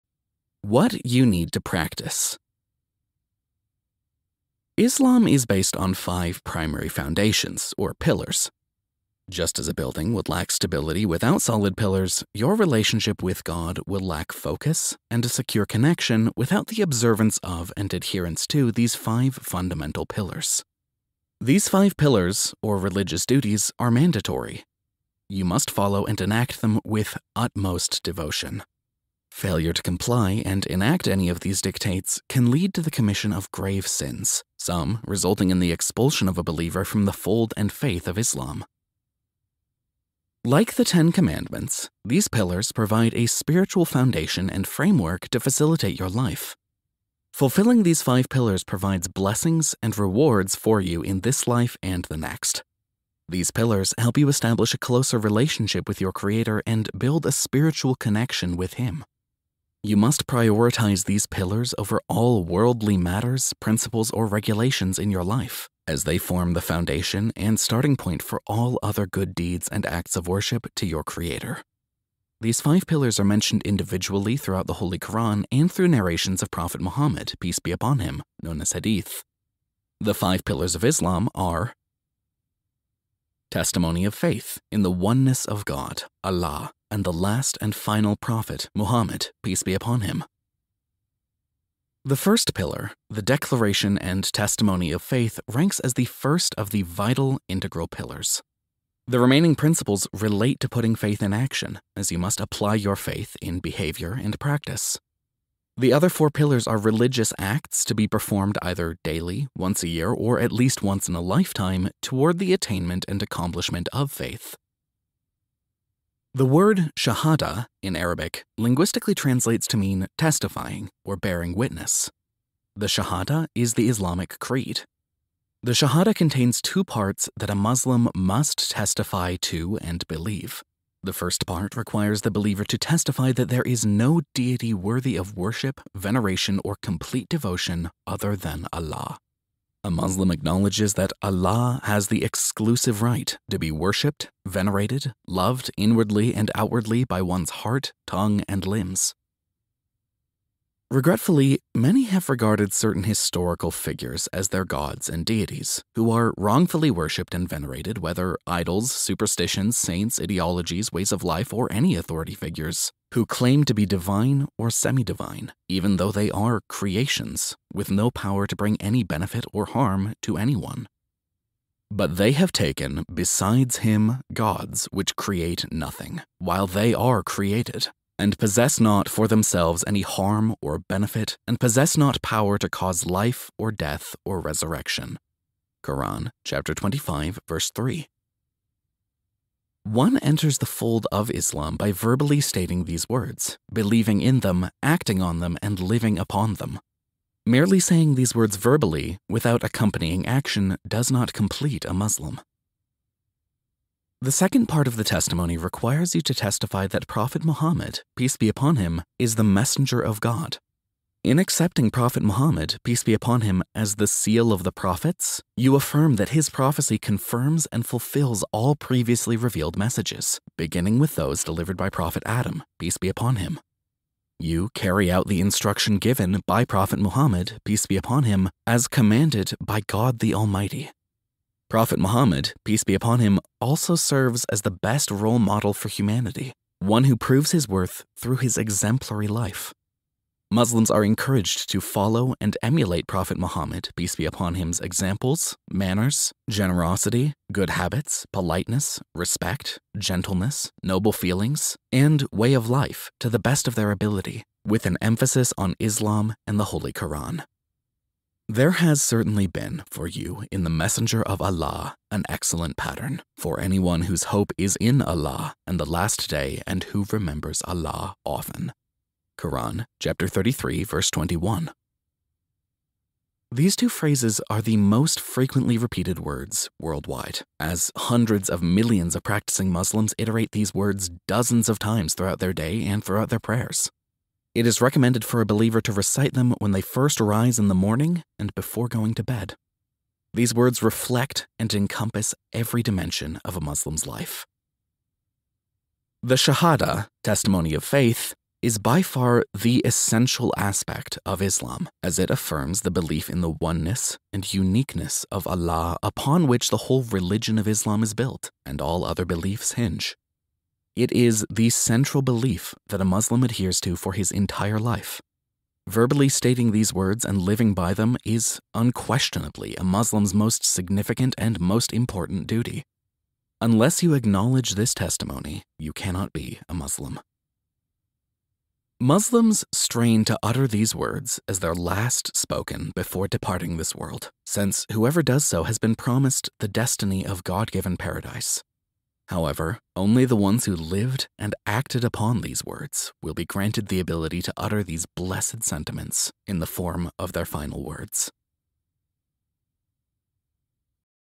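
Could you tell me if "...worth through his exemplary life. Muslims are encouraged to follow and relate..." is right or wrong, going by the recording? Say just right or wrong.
wrong.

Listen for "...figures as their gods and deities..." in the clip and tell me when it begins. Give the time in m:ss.
2:33.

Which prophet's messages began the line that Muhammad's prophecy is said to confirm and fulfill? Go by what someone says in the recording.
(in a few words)
Adam.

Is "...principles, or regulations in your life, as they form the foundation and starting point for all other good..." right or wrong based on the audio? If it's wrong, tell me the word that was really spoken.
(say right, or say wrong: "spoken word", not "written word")
right.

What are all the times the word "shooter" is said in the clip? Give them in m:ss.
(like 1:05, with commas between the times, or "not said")
not said.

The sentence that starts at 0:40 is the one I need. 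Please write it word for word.
Like the Ten Commandments, these pillars provide a spiritual foundation and framework to facilitate your life.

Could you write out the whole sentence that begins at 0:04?
Islam is based on five primary foundations, or pillars.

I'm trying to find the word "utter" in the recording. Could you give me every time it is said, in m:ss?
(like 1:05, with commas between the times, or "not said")
5:30, 5:44.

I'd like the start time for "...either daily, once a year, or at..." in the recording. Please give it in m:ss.
1:48.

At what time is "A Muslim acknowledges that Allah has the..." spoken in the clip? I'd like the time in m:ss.
2:19.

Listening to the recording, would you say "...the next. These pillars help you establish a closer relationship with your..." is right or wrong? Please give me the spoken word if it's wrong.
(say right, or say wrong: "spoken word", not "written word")
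right.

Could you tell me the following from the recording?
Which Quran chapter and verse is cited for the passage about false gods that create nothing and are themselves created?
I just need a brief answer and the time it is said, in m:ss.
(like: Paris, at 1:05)
Chapter 25, verse 3, at 3:05.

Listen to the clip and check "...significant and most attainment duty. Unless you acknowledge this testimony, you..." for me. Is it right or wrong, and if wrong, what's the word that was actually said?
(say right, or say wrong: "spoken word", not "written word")
wrong: "important", not "attainment".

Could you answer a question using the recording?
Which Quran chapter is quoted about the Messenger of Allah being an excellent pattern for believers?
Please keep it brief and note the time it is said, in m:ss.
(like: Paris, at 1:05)
Chapter 33, at 4:29.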